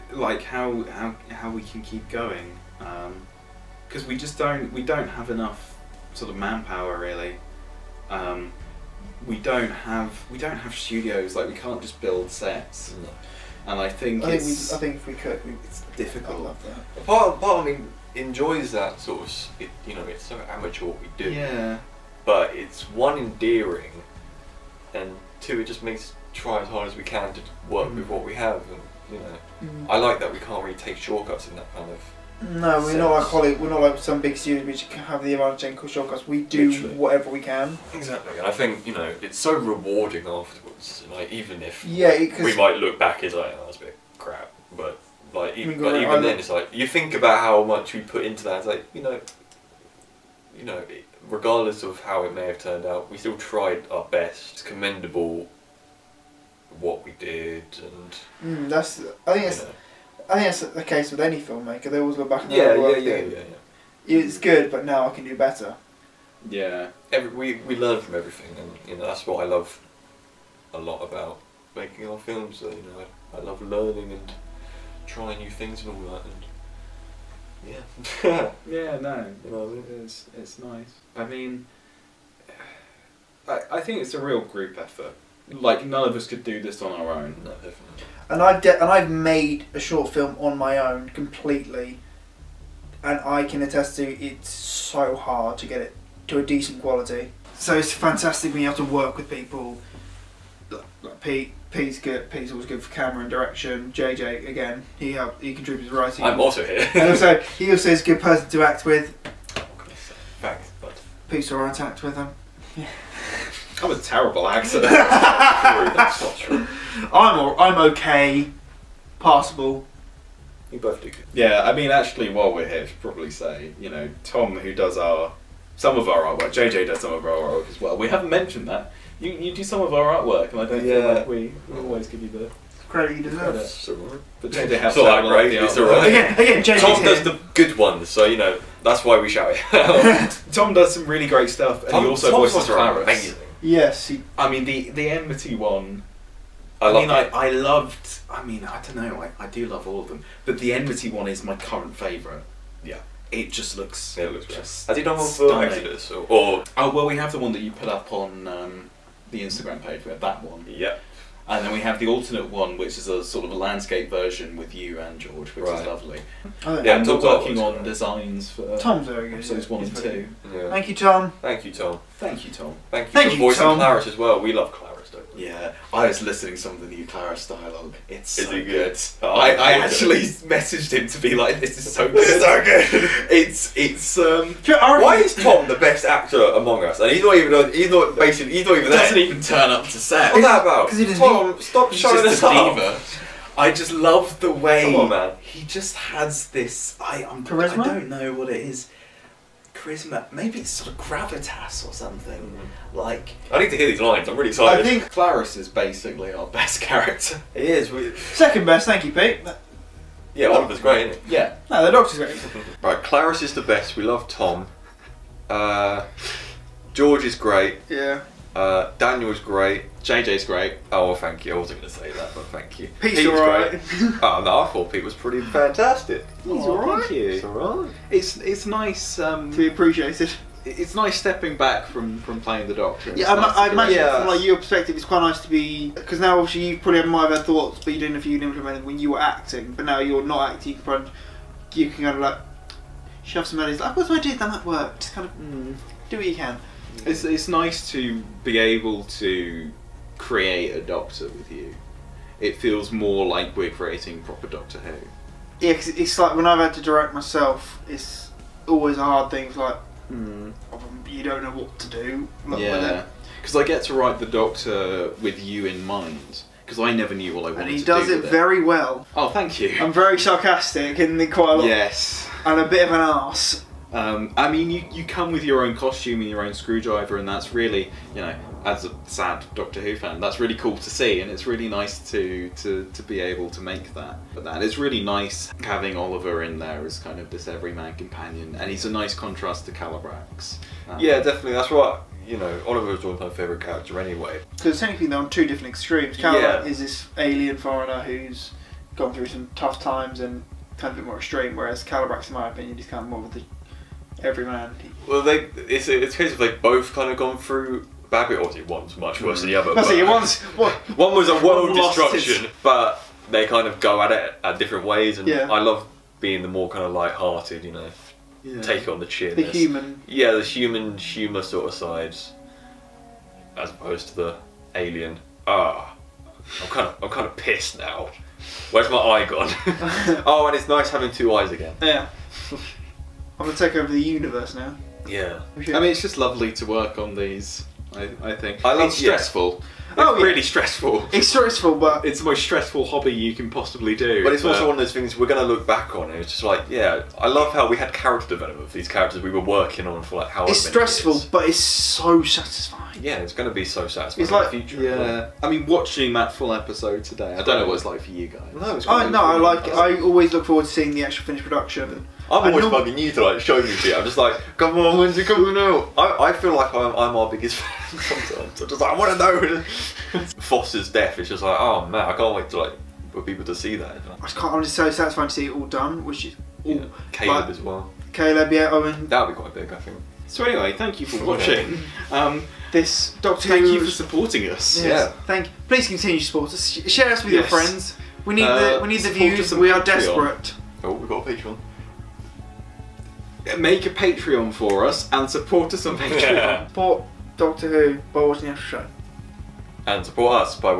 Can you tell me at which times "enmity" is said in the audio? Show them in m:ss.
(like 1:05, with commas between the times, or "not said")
2:25, 2:30.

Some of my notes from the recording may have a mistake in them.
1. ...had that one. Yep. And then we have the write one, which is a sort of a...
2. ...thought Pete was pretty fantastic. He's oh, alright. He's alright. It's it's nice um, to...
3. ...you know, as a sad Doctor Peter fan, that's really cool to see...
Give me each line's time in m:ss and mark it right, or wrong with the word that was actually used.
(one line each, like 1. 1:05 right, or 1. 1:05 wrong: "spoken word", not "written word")
1. 2:40 wrong: "alternate", not "write"
2. 3:44 right
3. 4:38 wrong: "Who", not "Peter".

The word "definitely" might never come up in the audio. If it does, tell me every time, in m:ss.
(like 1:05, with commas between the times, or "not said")
1:27, 4:51.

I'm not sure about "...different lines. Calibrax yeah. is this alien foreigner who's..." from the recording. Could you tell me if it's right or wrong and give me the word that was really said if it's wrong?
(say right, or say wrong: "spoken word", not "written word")
wrong: "extremes", not "lines".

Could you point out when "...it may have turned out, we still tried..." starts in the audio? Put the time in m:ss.
0:52.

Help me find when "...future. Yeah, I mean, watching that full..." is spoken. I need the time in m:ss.
5:54.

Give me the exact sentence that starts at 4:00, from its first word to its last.
You can, you can kind of like shove some money.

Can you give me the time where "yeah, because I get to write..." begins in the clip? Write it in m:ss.
4:22.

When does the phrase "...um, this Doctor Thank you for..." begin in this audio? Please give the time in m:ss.
6:22.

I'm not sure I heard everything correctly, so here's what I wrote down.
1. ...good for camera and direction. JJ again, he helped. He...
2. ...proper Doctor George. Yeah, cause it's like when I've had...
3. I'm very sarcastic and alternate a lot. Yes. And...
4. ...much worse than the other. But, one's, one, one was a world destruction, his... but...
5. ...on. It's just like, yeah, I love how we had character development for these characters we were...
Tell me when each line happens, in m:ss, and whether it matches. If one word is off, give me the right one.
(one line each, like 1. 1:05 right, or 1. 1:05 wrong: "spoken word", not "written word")
1. 1:42 right
2. 4:14 wrong: "Who", not "George"
3. 4:29 wrong: "quite", not "alternate"
4. 5:08 right
5. 5:45 right.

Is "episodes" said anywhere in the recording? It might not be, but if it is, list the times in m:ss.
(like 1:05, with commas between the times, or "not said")
2:49, 5:56.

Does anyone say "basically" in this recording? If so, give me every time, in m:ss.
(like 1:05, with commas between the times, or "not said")
3:08, 3:25.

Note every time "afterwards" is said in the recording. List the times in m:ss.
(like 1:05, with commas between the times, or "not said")
0:40.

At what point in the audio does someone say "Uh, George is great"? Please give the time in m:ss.
3:35.